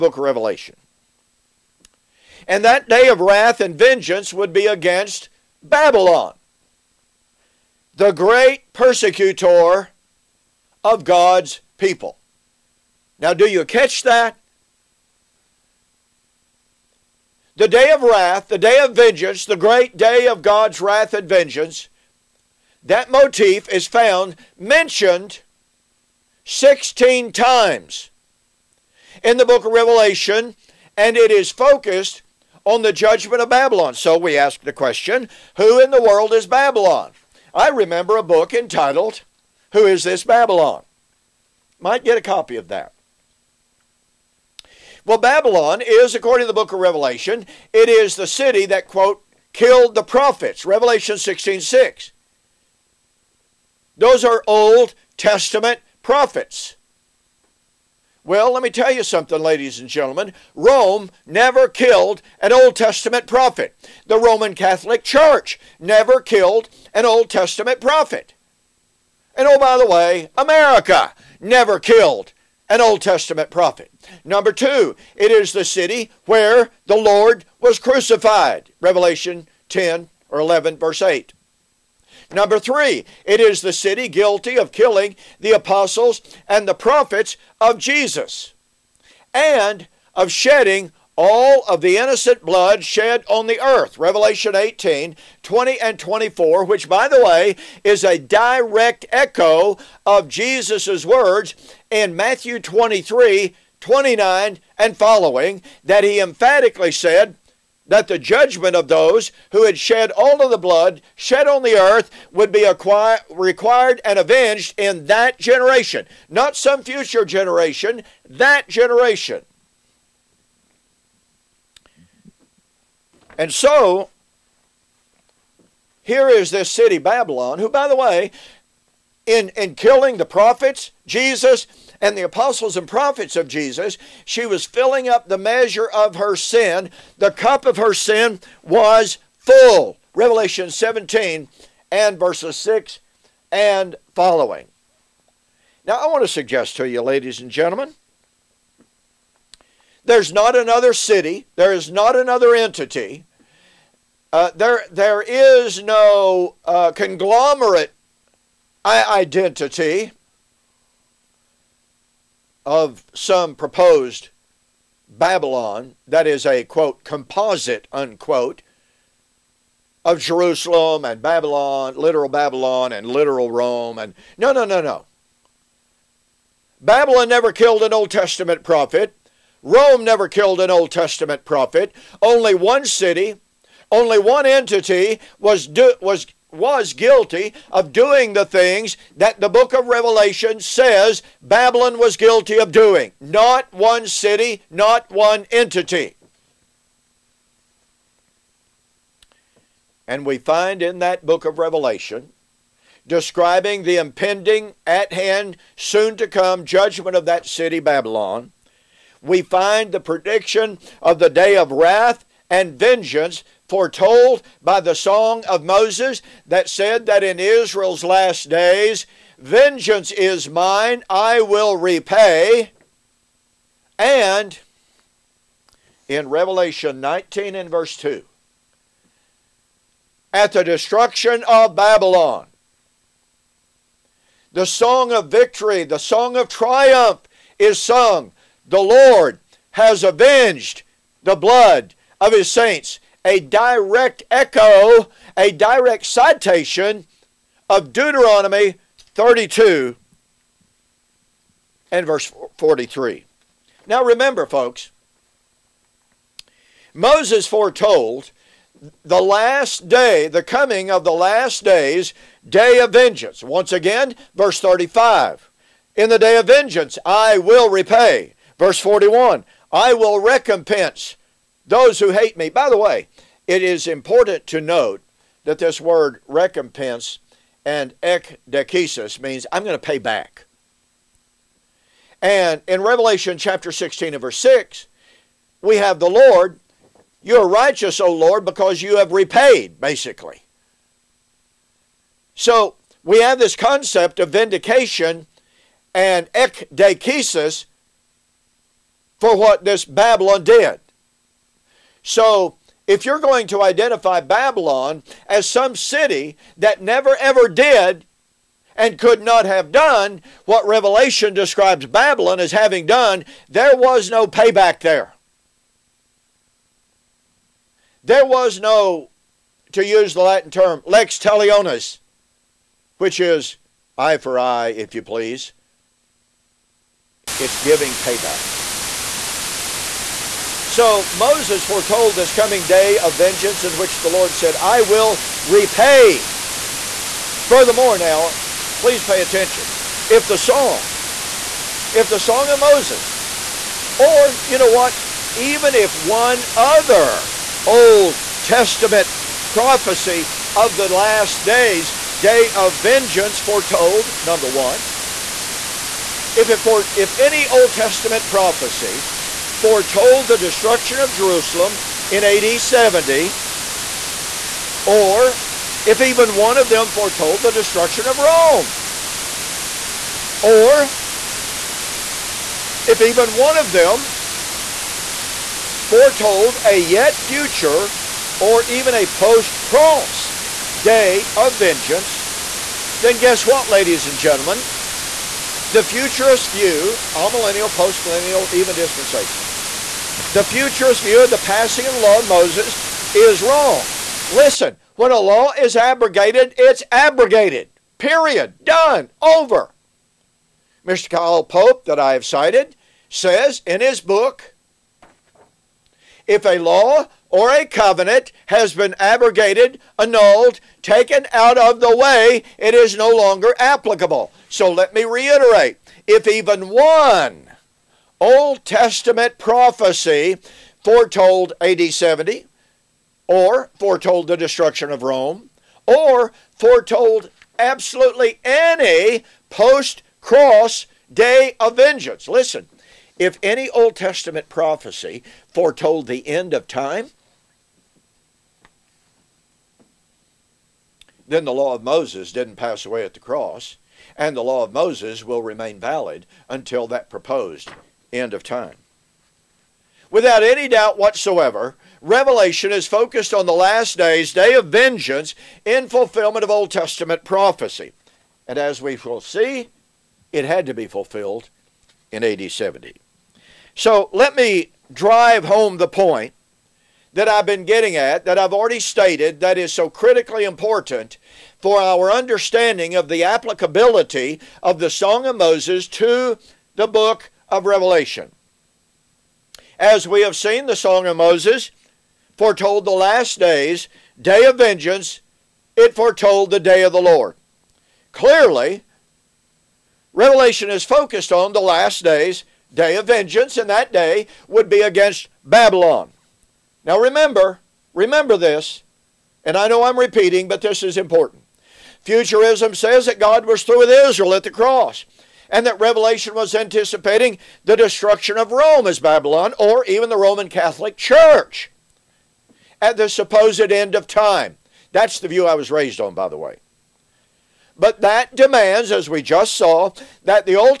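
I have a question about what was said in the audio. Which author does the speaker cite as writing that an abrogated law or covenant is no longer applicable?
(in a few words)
Kyle Pope.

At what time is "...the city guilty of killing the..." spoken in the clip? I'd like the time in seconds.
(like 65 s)
83 s.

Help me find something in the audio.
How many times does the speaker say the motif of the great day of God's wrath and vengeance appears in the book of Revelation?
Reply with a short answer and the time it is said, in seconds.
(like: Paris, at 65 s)
16, at 26 s.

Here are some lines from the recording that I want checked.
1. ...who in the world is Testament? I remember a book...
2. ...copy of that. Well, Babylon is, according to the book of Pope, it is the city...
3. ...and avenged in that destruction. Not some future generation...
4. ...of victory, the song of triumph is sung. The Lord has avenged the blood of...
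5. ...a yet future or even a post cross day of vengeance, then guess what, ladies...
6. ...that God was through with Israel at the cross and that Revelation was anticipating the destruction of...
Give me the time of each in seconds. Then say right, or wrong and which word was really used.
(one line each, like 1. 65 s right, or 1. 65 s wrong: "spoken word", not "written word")
1. 35 s wrong: "Babylon", not "Testament"
2. 42 s wrong: "Revelation", not "Pope"
3. 114 s wrong: "generation", not "destruction"
4. 235 s right
5. 376 s right
6. 503 s right.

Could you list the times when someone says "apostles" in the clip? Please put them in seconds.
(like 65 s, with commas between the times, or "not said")
85 s, 132 s.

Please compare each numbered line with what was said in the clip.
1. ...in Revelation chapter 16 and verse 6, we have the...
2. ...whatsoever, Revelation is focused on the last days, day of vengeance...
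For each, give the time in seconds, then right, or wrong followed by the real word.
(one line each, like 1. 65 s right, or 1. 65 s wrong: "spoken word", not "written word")
1. 282 s right
2. 450 s right.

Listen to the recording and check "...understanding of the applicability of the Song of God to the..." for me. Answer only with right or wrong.
wrong.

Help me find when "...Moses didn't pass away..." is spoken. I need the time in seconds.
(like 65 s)
441 s.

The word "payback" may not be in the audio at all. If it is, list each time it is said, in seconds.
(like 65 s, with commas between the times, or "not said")
314 s, 327 s.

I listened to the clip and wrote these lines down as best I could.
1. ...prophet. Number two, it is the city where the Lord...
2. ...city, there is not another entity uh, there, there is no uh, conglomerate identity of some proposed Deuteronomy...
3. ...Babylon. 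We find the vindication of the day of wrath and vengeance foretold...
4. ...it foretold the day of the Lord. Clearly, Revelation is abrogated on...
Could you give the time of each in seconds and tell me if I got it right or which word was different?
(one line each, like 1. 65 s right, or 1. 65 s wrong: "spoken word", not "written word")
1. 73 s right
2. 150 s wrong: "Babylon", not "Deuteronomy"
3. 207 s wrong: "prediction", not "vindication"
4. 485 s wrong: "focused", not "abrogated".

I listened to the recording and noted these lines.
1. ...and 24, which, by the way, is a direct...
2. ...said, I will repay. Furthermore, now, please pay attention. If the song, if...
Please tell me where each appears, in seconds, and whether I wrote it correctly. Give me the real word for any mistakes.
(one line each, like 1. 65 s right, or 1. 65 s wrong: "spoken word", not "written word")
1. 95 s right
2. 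334 s right.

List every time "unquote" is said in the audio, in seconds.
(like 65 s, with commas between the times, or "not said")
167 s.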